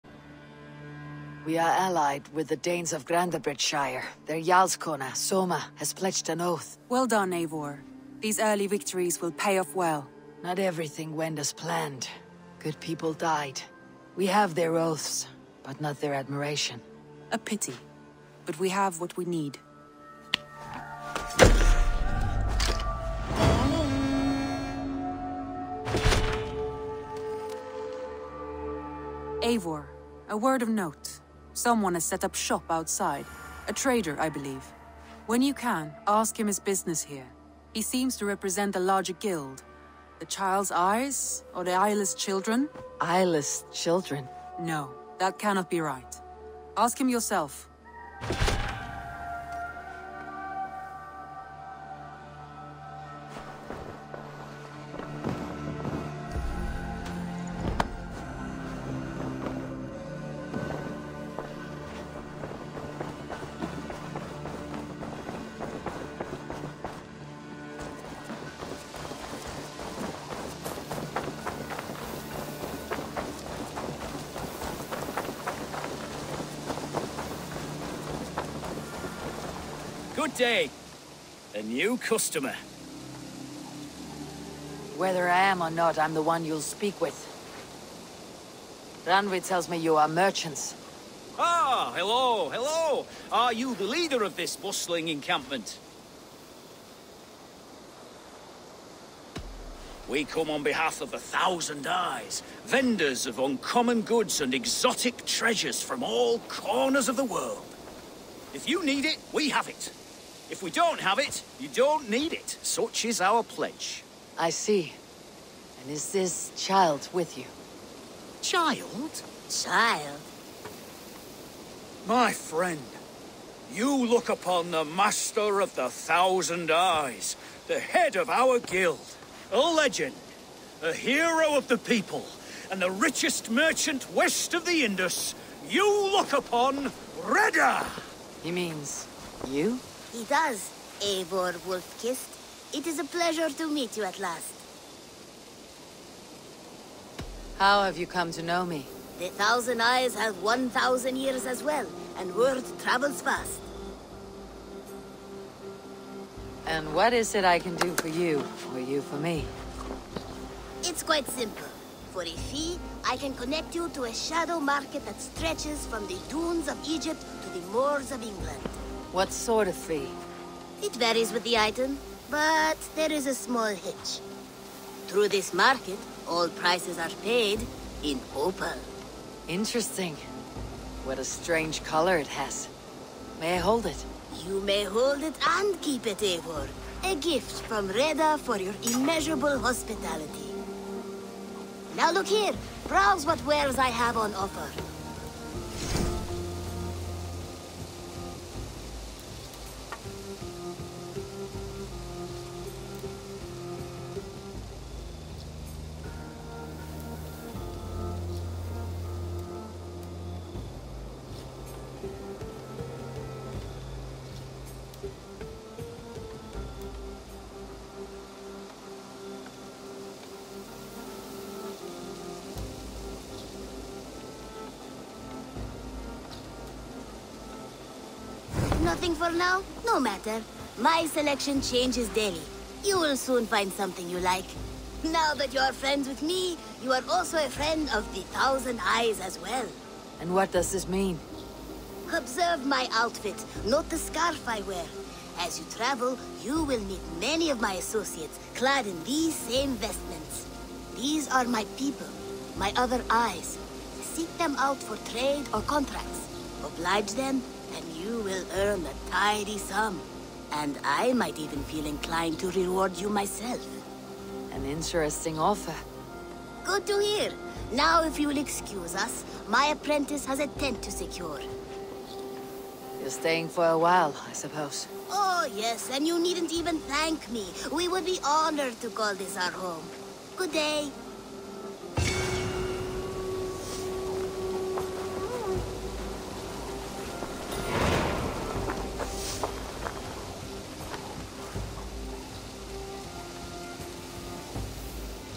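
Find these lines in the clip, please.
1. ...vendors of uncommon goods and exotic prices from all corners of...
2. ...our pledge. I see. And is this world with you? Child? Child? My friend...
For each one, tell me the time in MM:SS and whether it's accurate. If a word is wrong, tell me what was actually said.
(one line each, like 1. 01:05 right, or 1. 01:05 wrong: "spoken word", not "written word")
1. 01:42 wrong: "treasures", not "prices"
2. 01:53 wrong: "child", not "world".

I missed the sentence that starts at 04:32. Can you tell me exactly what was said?
You're staying for a while, I suppose.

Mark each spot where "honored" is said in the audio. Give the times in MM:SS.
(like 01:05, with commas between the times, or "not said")
04:38.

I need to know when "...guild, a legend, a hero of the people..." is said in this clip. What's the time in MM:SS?
02:08.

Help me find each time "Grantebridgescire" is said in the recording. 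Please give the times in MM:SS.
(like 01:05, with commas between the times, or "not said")
00:03.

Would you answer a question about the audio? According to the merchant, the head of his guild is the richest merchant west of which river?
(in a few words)
Indus.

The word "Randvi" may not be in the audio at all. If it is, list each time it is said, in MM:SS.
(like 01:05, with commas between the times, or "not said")
01:29.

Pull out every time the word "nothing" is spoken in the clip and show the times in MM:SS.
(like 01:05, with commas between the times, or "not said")
03:48.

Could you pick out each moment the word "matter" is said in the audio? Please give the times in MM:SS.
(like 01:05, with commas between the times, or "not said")
03:50.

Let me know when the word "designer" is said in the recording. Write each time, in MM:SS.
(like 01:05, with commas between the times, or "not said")
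not said.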